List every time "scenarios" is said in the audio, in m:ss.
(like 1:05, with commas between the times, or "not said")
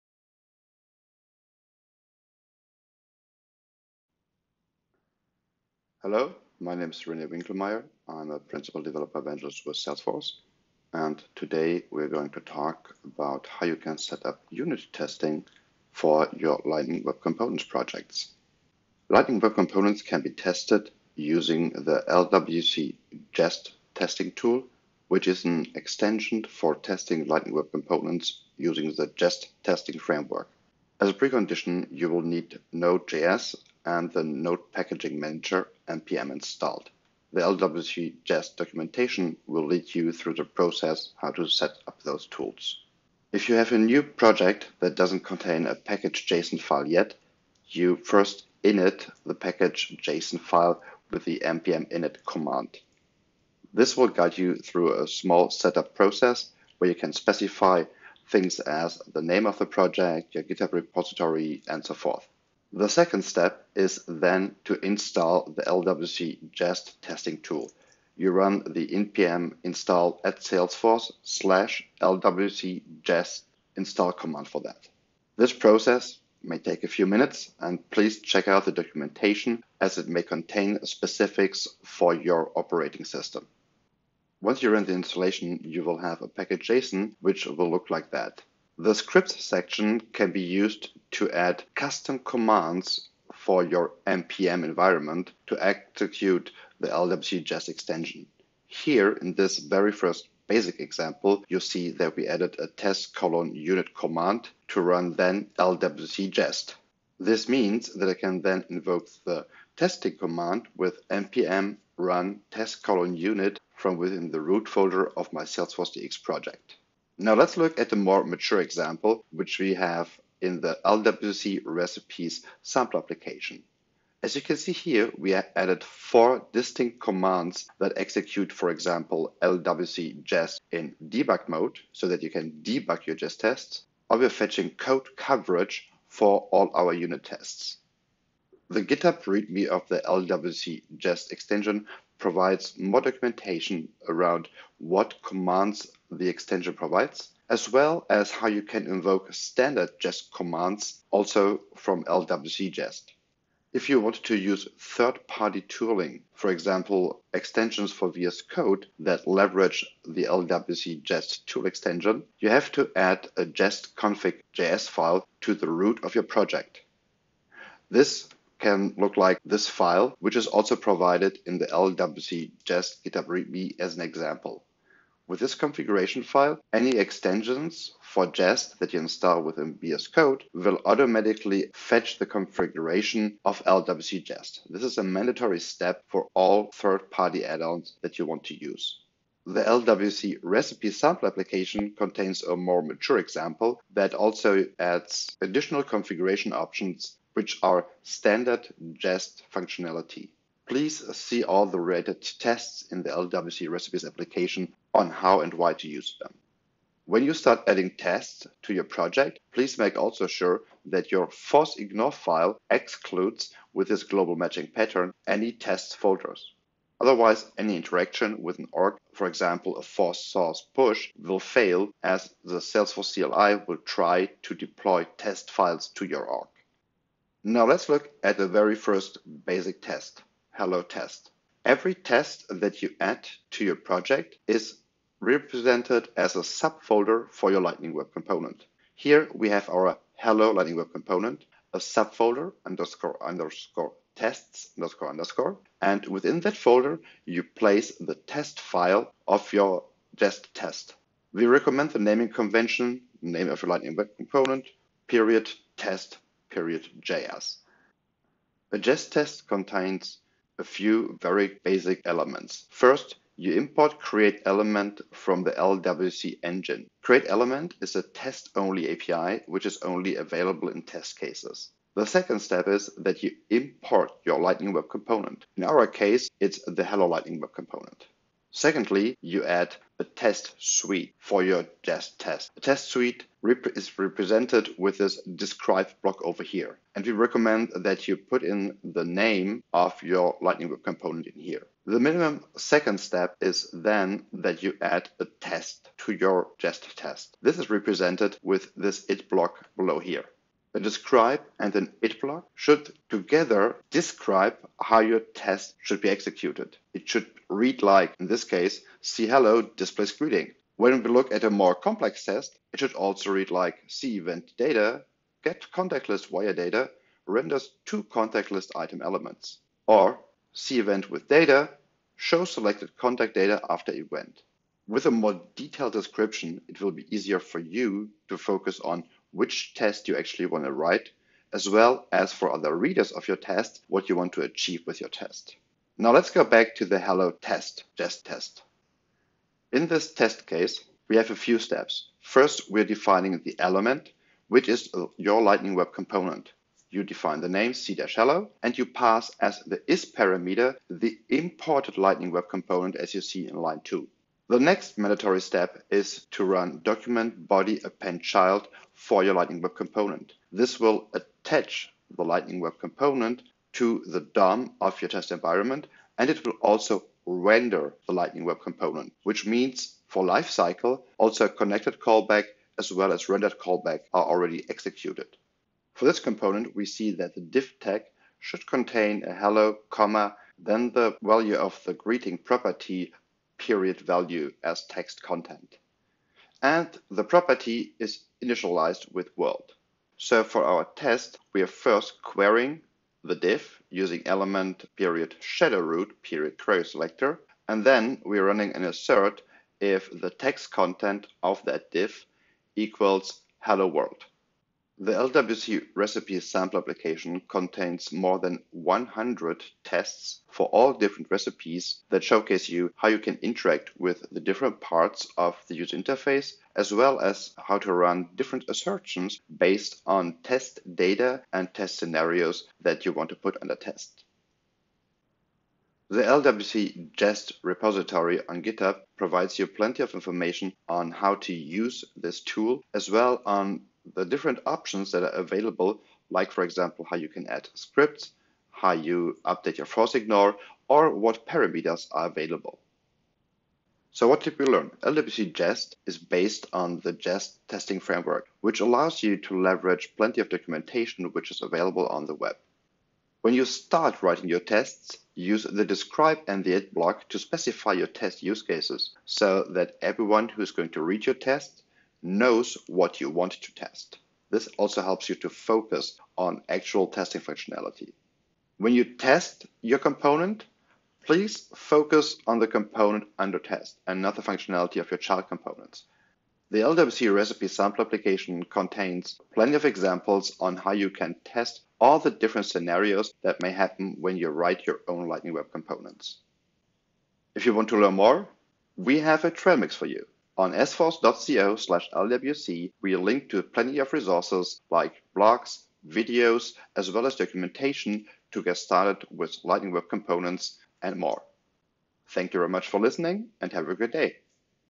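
7:01, 8:02.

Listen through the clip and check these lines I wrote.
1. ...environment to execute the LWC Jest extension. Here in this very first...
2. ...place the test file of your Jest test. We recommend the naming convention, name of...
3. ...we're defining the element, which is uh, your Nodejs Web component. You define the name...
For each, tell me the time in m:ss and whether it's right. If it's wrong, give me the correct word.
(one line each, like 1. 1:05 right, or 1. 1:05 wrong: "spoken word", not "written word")
1. 1:34 right
2. 4:07 right
3. 5:42 wrong: "Lightning", not "Nodejs".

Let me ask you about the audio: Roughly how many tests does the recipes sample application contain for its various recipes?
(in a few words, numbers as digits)
More than 100.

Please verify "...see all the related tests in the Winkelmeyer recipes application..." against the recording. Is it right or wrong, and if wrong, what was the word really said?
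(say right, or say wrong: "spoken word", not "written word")
wrong: "LWC", not "Winkelmeyer".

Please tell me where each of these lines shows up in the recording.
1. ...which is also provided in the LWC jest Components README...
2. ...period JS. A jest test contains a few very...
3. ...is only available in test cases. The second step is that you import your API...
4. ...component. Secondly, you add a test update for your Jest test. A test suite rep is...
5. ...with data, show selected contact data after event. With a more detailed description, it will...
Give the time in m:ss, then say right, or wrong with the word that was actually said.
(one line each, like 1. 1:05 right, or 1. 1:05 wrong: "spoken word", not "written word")
1. 2:50 wrong: "GitHub", not "Components"
2. 4:16 right
3. 4:29 wrong: "Lightning", not "API"
4. 4:37 wrong: "suite", not "update"
5. 5:21 right.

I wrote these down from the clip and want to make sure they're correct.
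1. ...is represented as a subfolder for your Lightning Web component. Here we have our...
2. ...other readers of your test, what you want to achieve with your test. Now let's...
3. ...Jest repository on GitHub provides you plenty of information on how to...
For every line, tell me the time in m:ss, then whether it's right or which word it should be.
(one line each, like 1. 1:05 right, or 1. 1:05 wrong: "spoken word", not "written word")
1. 3:54 right
2. 5:32 right
3. 7:07 right.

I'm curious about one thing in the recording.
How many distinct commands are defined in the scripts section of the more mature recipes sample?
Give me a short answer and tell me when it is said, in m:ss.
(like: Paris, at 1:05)
4, at 2:05.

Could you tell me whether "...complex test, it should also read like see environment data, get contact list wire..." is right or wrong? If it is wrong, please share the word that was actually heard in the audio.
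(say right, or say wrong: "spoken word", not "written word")
wrong: "event", not "environment".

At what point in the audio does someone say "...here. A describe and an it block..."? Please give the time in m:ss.
4:59.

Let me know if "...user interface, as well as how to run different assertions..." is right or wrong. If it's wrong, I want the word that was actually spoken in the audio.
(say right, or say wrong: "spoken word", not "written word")
right.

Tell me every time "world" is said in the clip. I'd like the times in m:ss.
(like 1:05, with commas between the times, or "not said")
6:29, 6:43.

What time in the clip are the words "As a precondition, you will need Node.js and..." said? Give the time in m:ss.
0:30.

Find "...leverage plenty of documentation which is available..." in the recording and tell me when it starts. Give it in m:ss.
7:29.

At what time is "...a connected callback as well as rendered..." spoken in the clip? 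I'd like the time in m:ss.
6:11.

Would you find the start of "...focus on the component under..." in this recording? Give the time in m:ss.
7:51.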